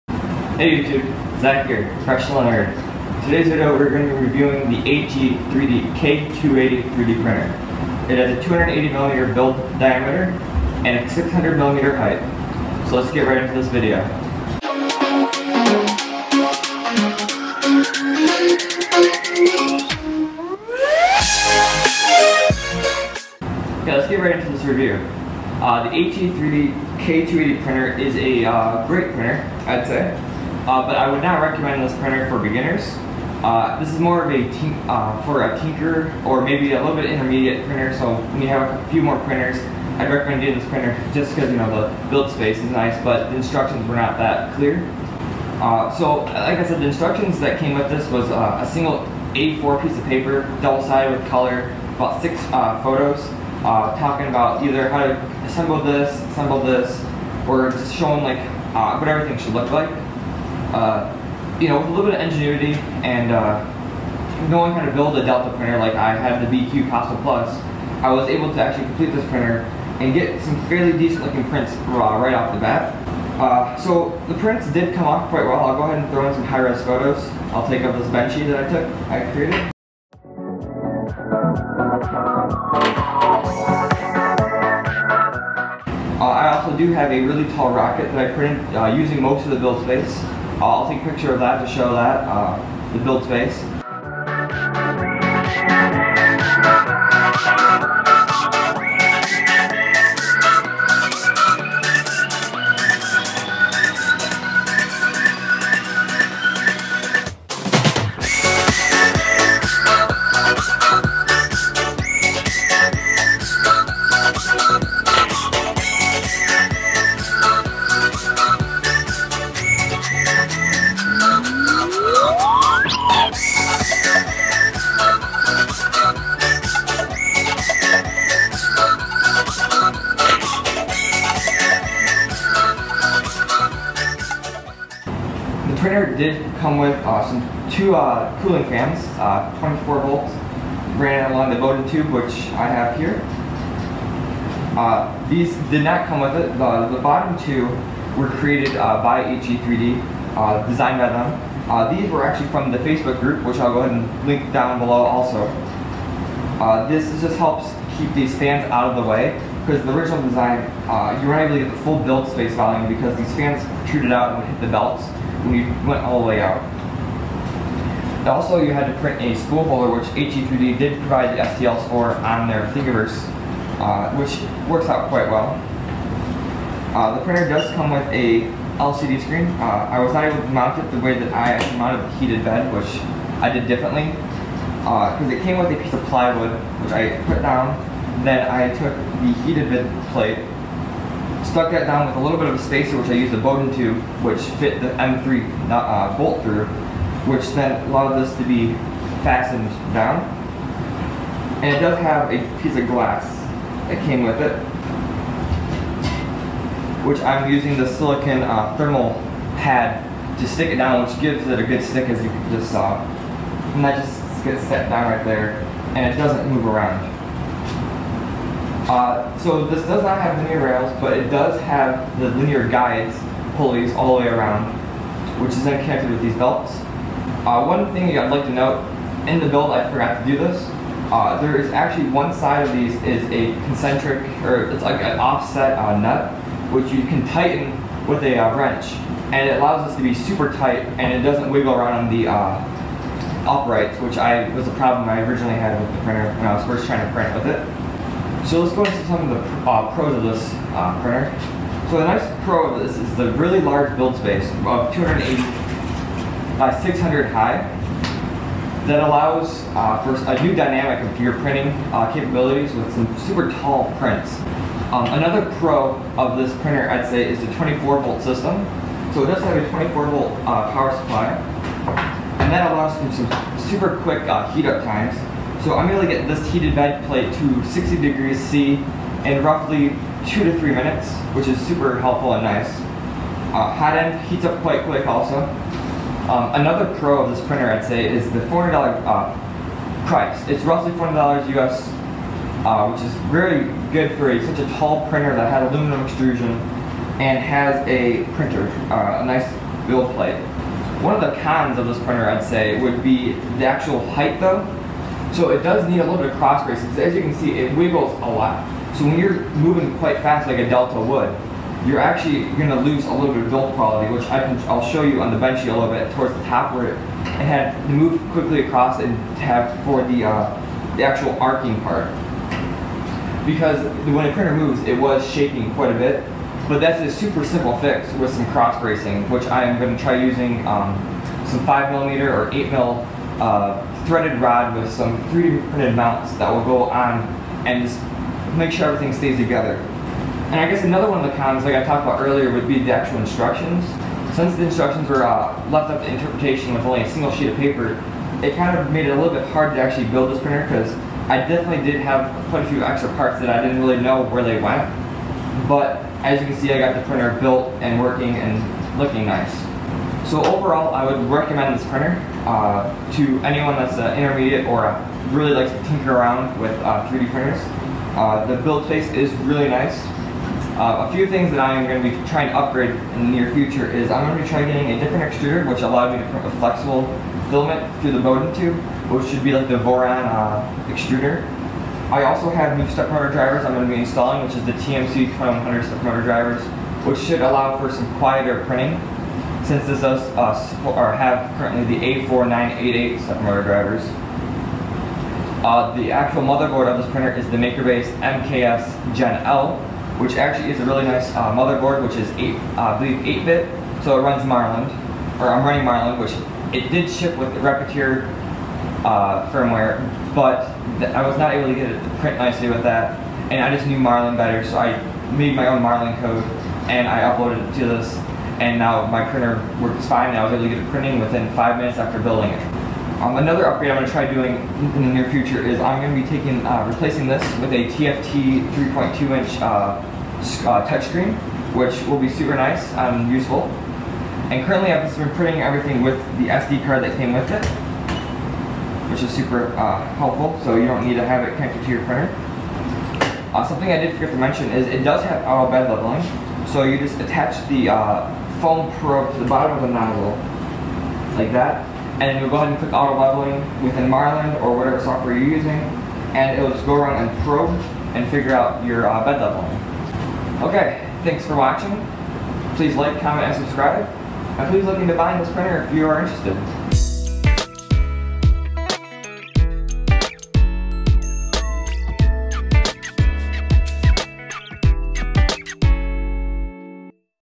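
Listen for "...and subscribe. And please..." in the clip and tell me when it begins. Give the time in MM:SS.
07:43.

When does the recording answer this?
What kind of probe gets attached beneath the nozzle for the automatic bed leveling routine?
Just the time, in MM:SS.
07:28.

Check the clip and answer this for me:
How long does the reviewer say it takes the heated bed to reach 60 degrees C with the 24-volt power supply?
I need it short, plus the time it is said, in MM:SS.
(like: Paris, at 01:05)
2 to 3 minutes, at 04:40.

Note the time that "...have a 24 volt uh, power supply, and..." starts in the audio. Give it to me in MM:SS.
04:29.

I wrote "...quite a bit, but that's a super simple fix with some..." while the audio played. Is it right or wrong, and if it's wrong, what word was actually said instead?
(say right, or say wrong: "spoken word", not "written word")
right.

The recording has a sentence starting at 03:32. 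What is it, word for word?
Uh, and that just gets set down right there, and it doesn't move around.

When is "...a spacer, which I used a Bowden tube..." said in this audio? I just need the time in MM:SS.
03:12.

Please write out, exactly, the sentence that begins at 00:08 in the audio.
It has a 280mm build diameter and a 600mm height.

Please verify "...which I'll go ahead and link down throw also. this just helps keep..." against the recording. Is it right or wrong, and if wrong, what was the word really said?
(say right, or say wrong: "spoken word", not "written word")
wrong: "below", not "throw".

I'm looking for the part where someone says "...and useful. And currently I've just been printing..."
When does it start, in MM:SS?
07:12.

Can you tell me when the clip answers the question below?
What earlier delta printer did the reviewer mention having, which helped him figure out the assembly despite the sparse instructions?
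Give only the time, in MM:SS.
01:06.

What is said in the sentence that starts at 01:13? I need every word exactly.
Uh, so the prints did come off quite well.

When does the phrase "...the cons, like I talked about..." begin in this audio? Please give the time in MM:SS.
05:41.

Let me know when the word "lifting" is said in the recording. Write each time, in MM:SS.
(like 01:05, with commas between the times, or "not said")
not said.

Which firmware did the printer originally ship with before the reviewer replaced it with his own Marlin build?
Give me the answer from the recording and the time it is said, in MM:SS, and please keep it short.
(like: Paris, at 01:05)
Repetier, at 06:47.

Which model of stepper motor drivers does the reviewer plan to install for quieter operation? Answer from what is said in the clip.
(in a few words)
TMC 2100.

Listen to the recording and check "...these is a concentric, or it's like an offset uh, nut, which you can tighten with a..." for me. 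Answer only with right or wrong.
right.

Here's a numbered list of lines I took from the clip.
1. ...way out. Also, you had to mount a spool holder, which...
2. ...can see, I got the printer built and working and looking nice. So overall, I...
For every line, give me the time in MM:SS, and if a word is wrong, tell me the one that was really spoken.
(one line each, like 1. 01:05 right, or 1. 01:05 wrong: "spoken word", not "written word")
1. 02:46 wrong: "print", not "mount"
2. 05:56 right.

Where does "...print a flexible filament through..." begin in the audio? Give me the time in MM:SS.
06:16.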